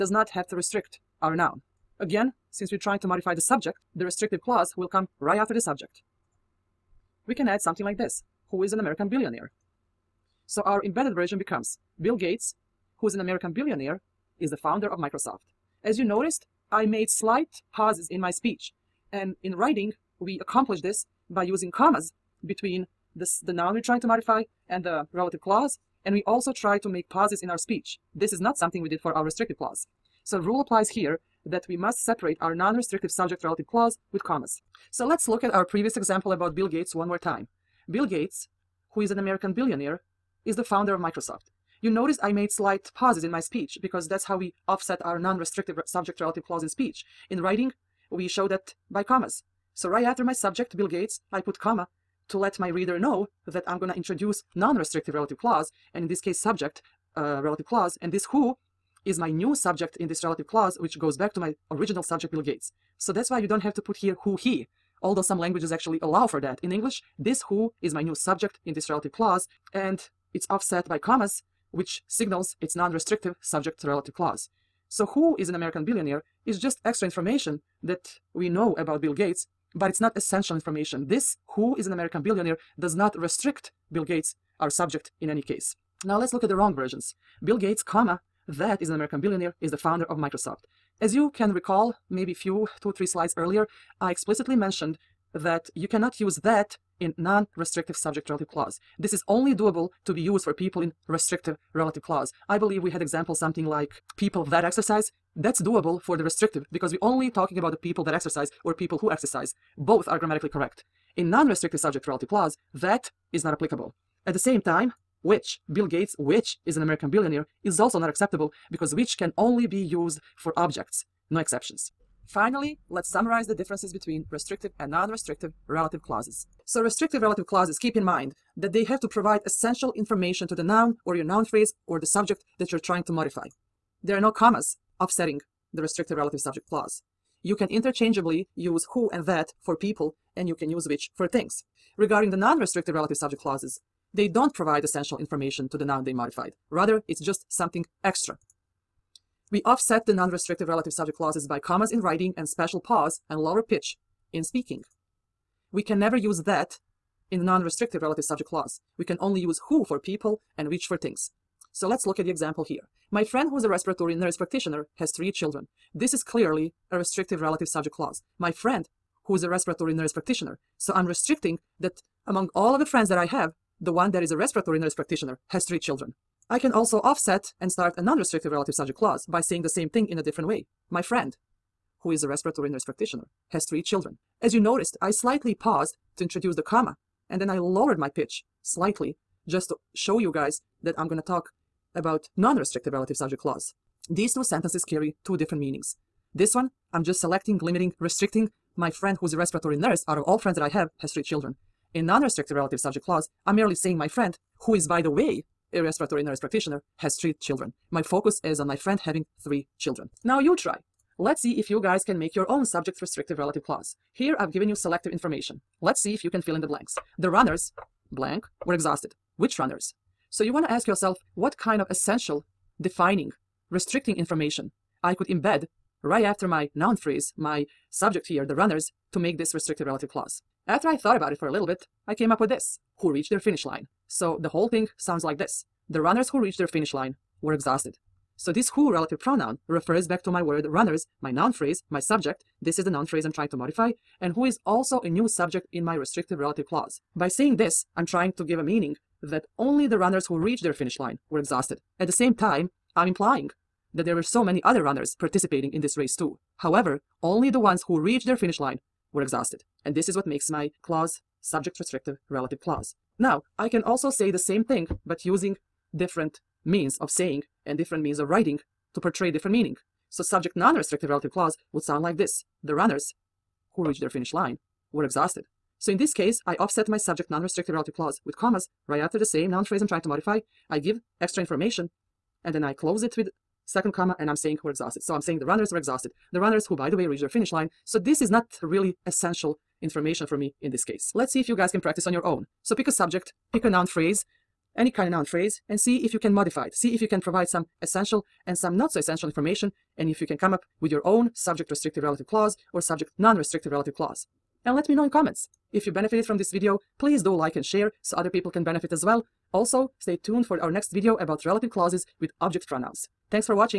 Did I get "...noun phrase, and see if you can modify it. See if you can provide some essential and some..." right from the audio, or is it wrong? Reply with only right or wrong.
right.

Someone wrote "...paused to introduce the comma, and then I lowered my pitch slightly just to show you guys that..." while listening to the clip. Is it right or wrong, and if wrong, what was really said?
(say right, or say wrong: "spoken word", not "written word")
right.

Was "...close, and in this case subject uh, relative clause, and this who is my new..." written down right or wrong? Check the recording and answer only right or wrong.
wrong.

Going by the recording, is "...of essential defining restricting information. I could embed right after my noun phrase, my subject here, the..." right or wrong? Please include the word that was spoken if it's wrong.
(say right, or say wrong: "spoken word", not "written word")
right.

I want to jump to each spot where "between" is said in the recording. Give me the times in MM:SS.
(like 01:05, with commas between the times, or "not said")
00:22, 02:03.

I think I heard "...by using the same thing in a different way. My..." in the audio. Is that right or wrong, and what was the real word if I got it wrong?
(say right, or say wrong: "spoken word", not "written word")
wrong: "saying", not "using".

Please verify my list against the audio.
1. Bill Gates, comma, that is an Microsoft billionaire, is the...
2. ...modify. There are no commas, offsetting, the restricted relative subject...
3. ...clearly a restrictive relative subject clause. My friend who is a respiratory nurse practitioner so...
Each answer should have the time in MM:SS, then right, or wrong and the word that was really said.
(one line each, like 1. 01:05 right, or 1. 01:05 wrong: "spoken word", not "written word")
1. 01:27 wrong: "American", not "Microsoft"
2. 02:13 right
3. 02:46 right.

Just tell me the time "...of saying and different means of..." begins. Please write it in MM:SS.
04:26.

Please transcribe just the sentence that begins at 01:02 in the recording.
So that's why you don't have to put here who he, although some languages actually allow for that.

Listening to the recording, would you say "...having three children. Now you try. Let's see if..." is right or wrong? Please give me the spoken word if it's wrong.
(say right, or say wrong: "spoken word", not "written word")
right.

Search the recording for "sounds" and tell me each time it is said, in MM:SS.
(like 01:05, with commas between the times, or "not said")
03:54, 04:31.